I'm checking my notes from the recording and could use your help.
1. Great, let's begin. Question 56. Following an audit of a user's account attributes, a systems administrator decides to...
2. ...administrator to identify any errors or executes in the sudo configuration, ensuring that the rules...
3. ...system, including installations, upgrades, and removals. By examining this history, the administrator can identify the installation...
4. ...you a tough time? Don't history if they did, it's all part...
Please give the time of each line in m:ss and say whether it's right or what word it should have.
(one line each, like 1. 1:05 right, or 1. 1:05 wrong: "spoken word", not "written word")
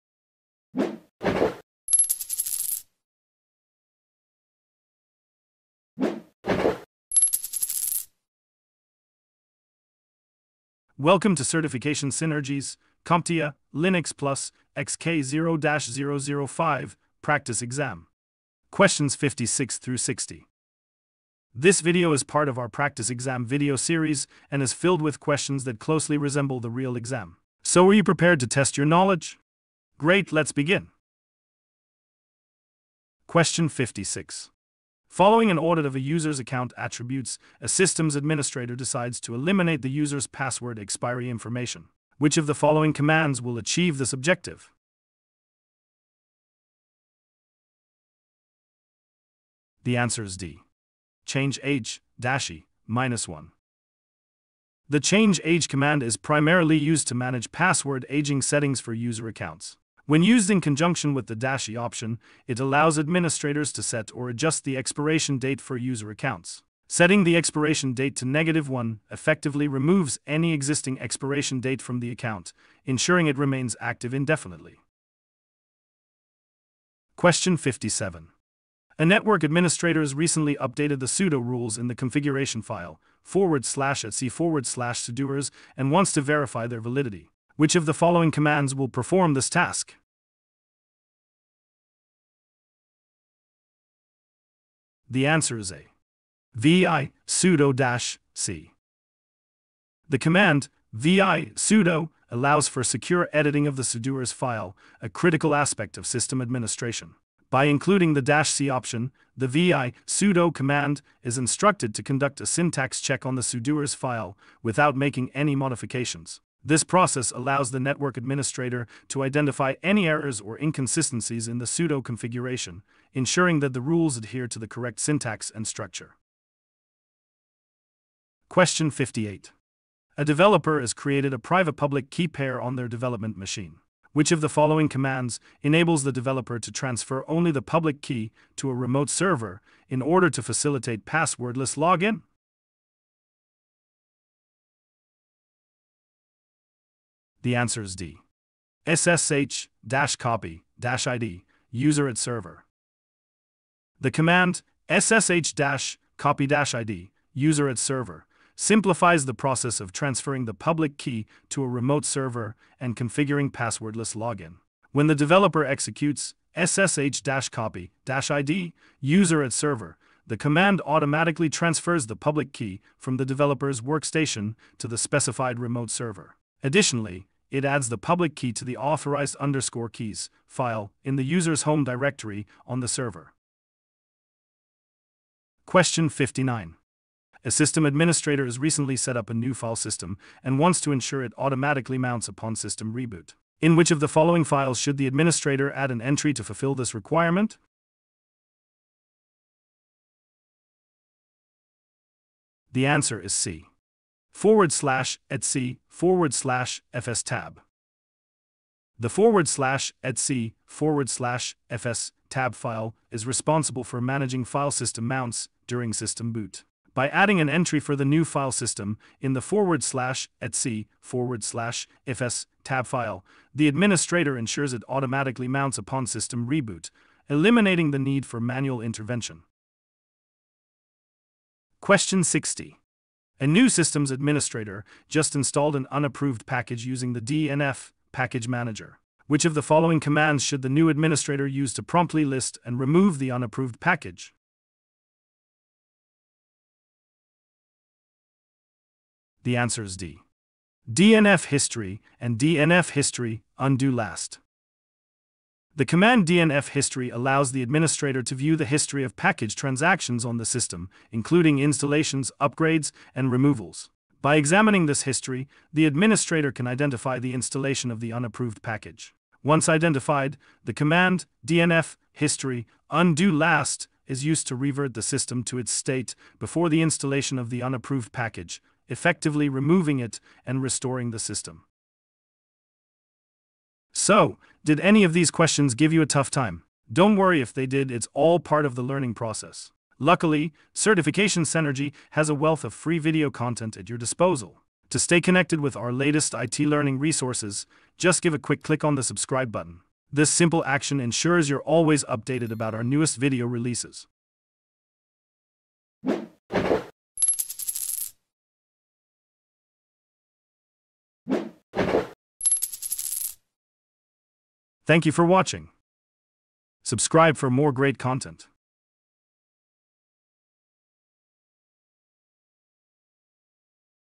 1. 0:29 right
2. 1:58 wrong: "inconsistencies", not "executes"
3. 4:20 right
4. 4:45 wrong: "worry", not "history".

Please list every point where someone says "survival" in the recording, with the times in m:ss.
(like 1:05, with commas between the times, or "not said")
not said.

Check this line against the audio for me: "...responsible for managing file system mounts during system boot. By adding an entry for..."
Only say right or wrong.
right.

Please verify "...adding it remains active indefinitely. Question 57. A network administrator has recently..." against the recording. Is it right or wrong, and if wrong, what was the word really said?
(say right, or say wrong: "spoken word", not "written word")
wrong: "ensuring", not "adding".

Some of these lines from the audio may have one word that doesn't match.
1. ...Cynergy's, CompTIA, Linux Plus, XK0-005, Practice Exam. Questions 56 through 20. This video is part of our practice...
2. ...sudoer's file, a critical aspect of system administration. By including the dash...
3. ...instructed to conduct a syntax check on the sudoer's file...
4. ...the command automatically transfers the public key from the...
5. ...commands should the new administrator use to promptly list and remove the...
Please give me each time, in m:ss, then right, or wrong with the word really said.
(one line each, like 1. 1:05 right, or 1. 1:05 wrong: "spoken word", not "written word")
1. 0:12 wrong: "60", not "20"
2. 1:43 right
3. 1:51 right
4. 2:50 right
5. 3:59 right.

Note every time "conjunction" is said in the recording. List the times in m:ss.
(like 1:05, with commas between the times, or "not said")
1:00.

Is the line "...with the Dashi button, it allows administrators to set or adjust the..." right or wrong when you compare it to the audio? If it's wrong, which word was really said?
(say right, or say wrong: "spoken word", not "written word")
wrong: "option", not "button".